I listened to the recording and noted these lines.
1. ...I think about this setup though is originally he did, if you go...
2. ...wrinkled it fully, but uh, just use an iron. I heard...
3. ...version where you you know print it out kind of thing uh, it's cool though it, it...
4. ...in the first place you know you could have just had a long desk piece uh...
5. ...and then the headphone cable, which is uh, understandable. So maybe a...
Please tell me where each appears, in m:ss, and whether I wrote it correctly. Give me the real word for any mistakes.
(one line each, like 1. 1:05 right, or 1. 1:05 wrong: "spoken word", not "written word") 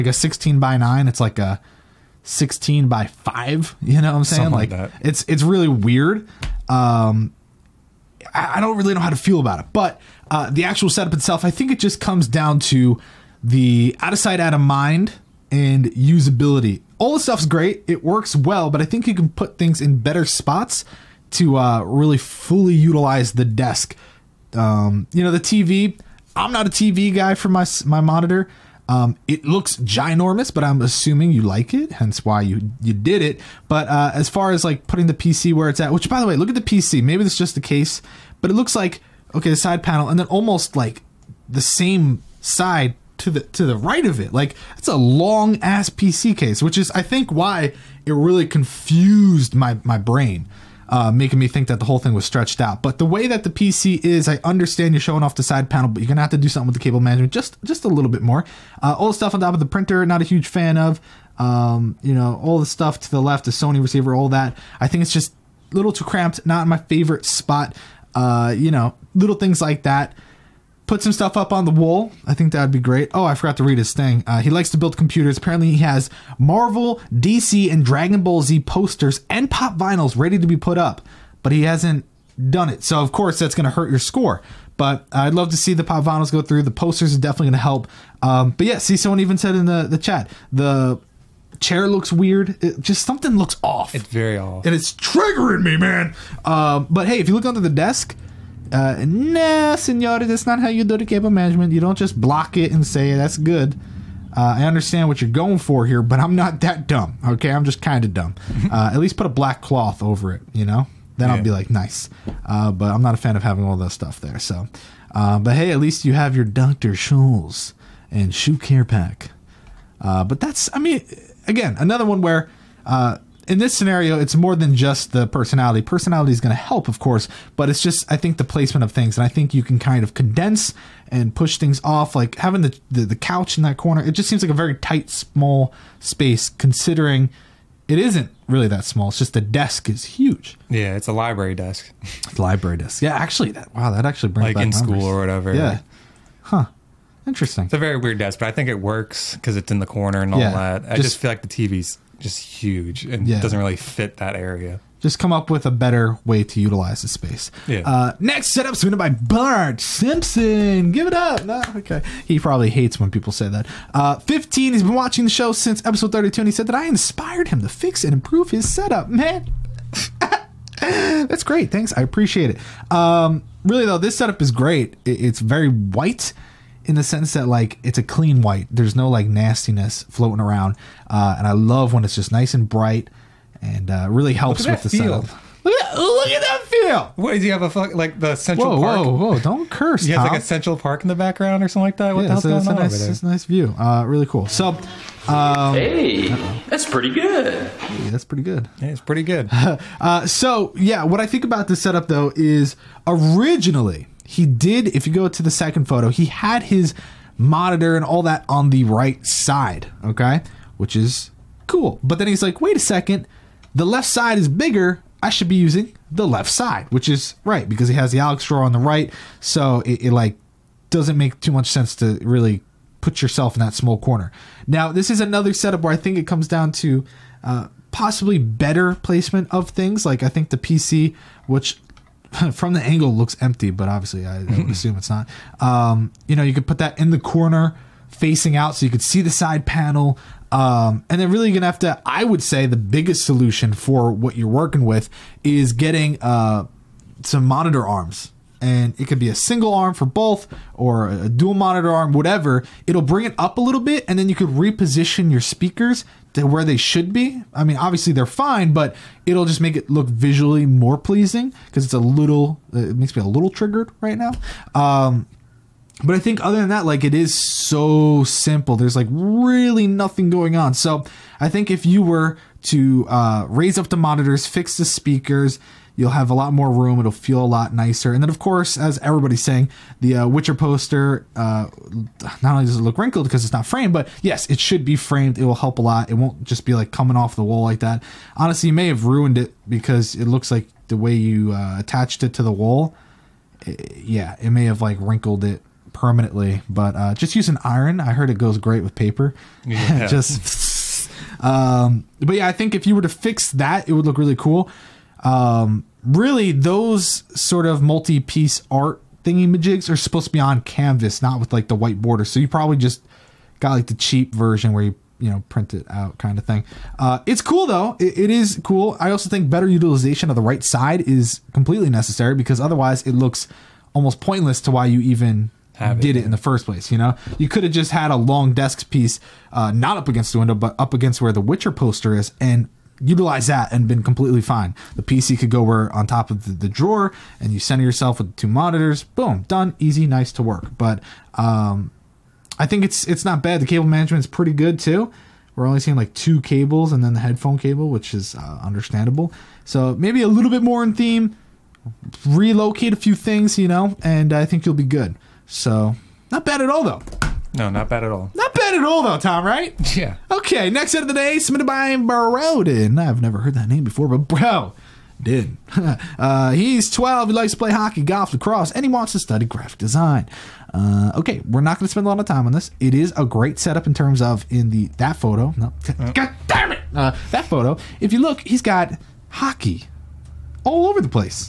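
1. 3:21 right
2. 4:54 wrong: "permanently", not "fully"
3. 5:14 right
4. 5:26 right
5. 5:46 right.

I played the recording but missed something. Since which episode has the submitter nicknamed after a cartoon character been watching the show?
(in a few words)
32.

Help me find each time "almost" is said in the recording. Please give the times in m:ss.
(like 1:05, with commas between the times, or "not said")
0:40, 5:23.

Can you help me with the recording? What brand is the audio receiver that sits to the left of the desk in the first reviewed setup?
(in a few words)
Sony.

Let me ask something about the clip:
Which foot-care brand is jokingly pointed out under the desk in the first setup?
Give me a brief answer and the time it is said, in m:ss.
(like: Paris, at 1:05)
Doctor Scholl's, at 1:56.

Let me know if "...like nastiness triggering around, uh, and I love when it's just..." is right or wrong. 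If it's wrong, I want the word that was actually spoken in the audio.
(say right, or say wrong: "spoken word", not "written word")
wrong: "floating", not "triggering".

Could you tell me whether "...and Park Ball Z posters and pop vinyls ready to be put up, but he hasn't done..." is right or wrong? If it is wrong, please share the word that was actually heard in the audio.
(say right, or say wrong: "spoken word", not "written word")
wrong: "Dragon", not "Park".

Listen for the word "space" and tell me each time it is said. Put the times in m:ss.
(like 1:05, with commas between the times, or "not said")
2:15, 2:37.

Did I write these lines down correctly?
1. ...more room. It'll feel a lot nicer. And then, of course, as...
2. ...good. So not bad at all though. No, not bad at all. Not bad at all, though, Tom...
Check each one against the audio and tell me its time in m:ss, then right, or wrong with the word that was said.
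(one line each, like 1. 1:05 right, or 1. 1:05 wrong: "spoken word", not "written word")
1. 4:36 right
2. 5:54 right.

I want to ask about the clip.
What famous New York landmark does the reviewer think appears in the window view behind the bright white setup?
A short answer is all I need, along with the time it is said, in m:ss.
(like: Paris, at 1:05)
Central Park, at 3:10.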